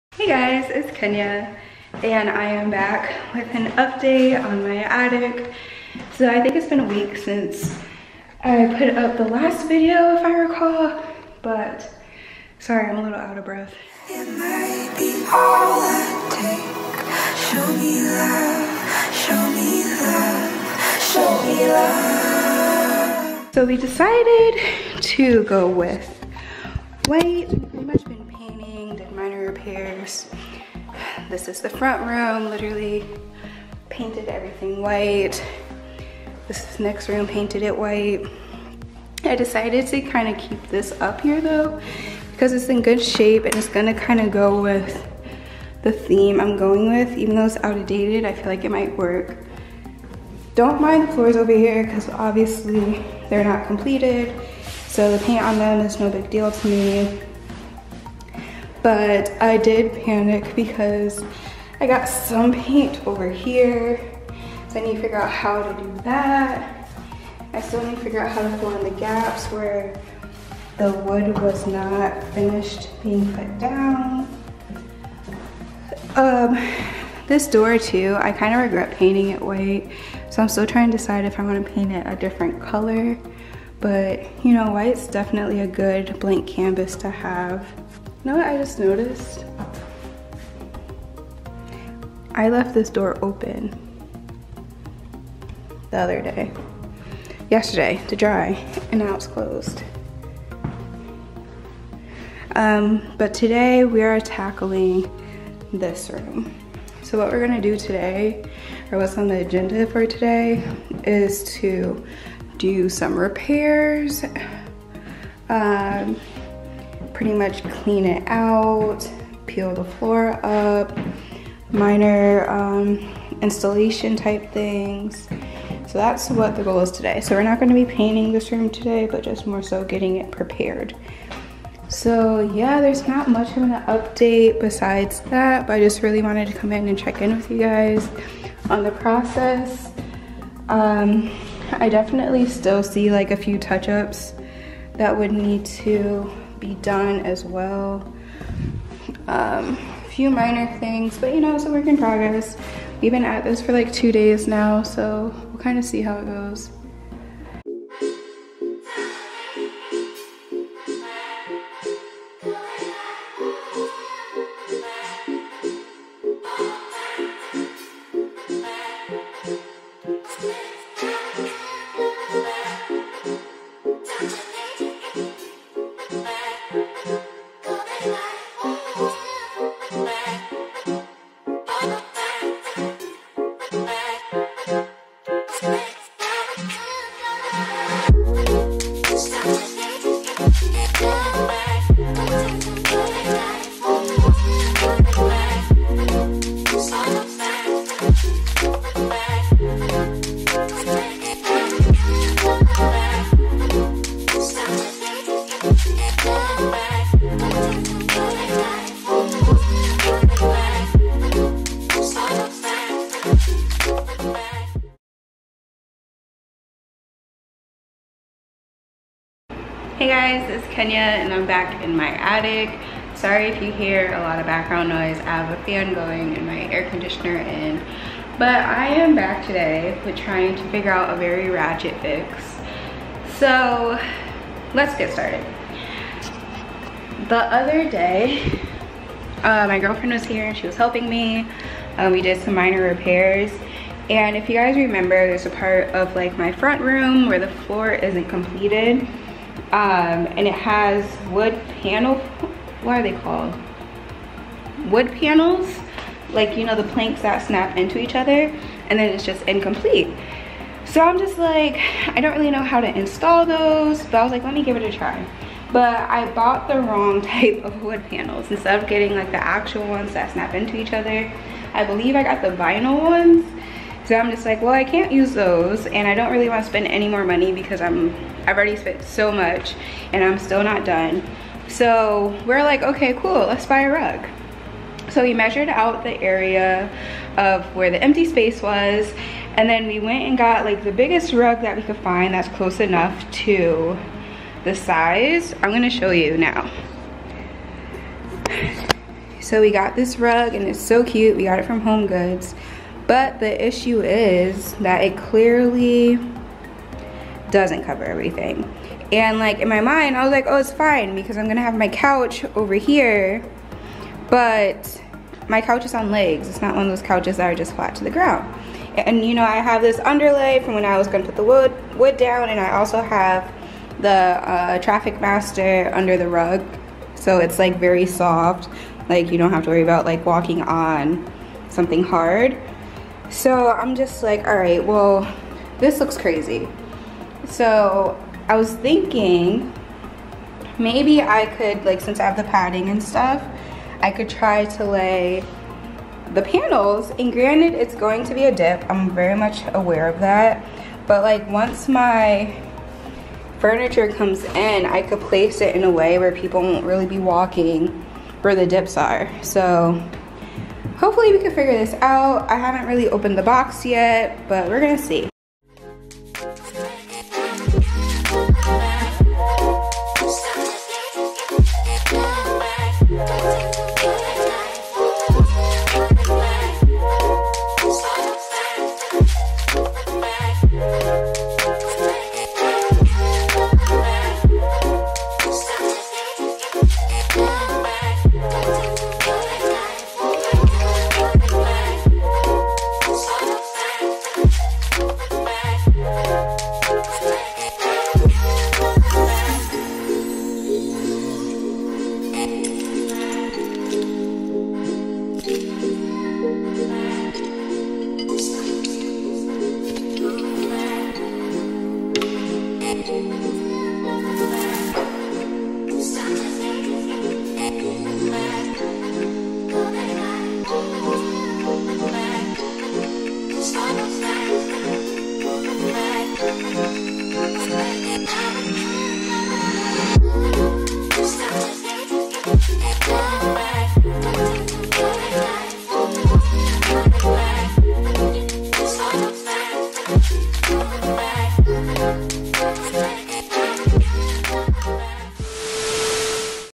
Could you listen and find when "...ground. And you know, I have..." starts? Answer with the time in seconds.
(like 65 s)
318 s.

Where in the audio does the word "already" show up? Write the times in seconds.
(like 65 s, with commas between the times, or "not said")
278 s.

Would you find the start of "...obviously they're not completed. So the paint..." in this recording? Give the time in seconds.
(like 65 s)
52 s.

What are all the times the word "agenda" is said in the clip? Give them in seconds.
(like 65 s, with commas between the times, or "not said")
109 s.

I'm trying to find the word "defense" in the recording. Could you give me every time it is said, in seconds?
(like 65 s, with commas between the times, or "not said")
not said.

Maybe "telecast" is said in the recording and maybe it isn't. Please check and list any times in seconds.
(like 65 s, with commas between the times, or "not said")
not said.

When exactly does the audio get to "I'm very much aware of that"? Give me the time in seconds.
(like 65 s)
348 s.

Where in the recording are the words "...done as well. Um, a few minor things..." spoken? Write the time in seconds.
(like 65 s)
146 s.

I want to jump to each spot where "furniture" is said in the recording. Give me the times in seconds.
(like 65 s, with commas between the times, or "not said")
353 s.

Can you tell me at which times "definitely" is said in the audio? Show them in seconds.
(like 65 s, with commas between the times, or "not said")
85 s, 141 s.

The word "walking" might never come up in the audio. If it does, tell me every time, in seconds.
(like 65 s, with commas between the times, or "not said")
330 s, 357 s.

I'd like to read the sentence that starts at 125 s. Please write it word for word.
So that's what the goal is today.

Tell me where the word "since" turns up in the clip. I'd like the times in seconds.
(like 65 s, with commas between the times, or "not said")
7 s, 342 s.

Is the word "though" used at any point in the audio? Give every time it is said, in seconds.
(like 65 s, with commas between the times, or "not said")
41 s, 47 s.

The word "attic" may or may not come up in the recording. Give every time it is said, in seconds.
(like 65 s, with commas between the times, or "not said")
4 s, 222 s.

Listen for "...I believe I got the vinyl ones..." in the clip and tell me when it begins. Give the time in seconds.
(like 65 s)
271 s.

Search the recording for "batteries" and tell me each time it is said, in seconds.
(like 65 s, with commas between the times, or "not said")
not said.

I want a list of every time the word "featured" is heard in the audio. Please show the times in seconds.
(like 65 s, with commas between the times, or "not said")
not said.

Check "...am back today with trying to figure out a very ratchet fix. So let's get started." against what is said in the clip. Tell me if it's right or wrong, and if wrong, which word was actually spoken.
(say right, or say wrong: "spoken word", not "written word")
right.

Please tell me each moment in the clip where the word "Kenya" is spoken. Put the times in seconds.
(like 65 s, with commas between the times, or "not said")
0 s, 220 s.